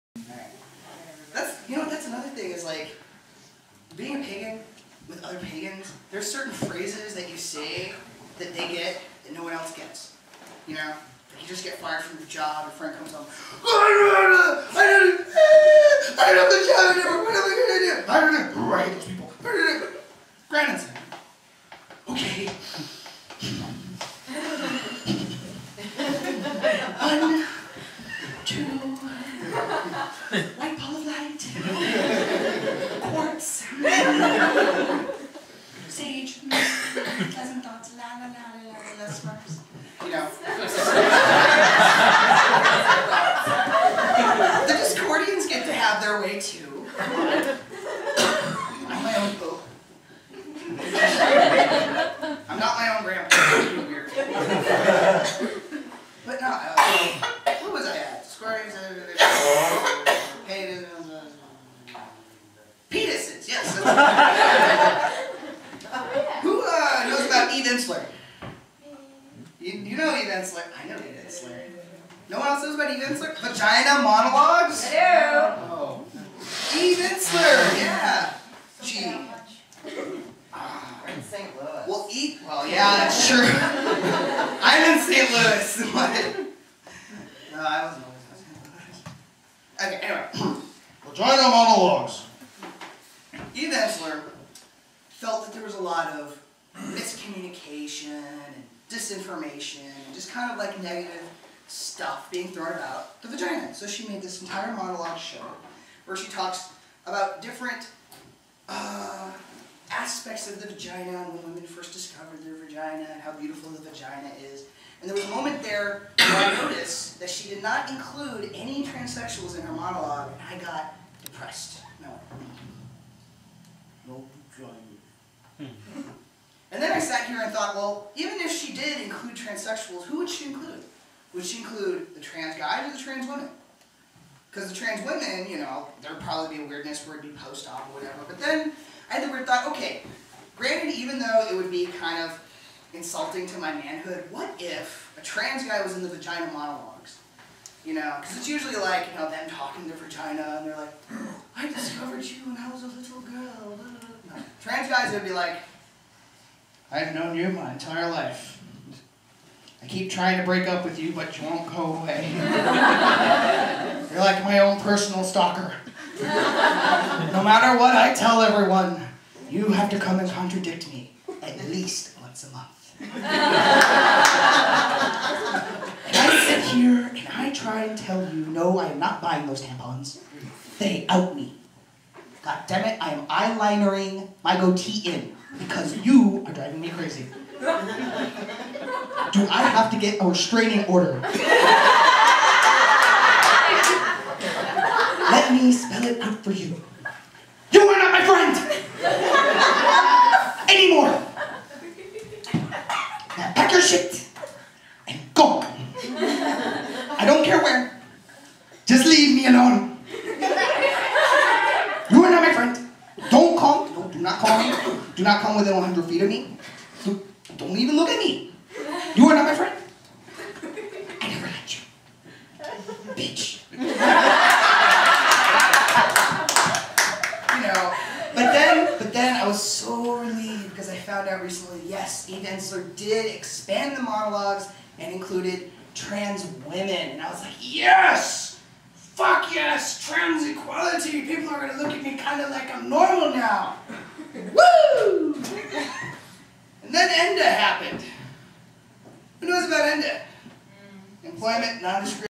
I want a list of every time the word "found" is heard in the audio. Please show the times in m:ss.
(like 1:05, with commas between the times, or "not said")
3:50.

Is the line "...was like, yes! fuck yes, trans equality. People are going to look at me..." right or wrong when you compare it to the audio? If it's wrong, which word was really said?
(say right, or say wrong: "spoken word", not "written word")
right.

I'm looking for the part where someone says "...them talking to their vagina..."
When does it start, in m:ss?
2:29.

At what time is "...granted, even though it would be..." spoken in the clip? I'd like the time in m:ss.
2:20.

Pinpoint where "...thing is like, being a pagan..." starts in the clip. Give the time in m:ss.
0:02.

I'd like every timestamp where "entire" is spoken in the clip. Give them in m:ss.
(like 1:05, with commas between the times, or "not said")
1:44, 2:37.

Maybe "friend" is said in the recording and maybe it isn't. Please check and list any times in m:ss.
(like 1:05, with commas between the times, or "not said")
0:12, 3:18, 3:39.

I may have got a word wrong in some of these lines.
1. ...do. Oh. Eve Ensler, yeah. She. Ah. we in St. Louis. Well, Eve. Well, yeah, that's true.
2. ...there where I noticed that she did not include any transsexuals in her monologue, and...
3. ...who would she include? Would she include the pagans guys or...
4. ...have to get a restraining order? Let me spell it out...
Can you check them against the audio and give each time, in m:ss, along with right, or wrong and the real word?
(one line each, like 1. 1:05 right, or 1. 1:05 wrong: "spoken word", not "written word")
1. 1:14 right
2. 1:55 right
3. 2:10 wrong: "trans", not "pagans"
4. 3:09 right.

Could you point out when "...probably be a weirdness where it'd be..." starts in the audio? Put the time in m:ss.
2:16.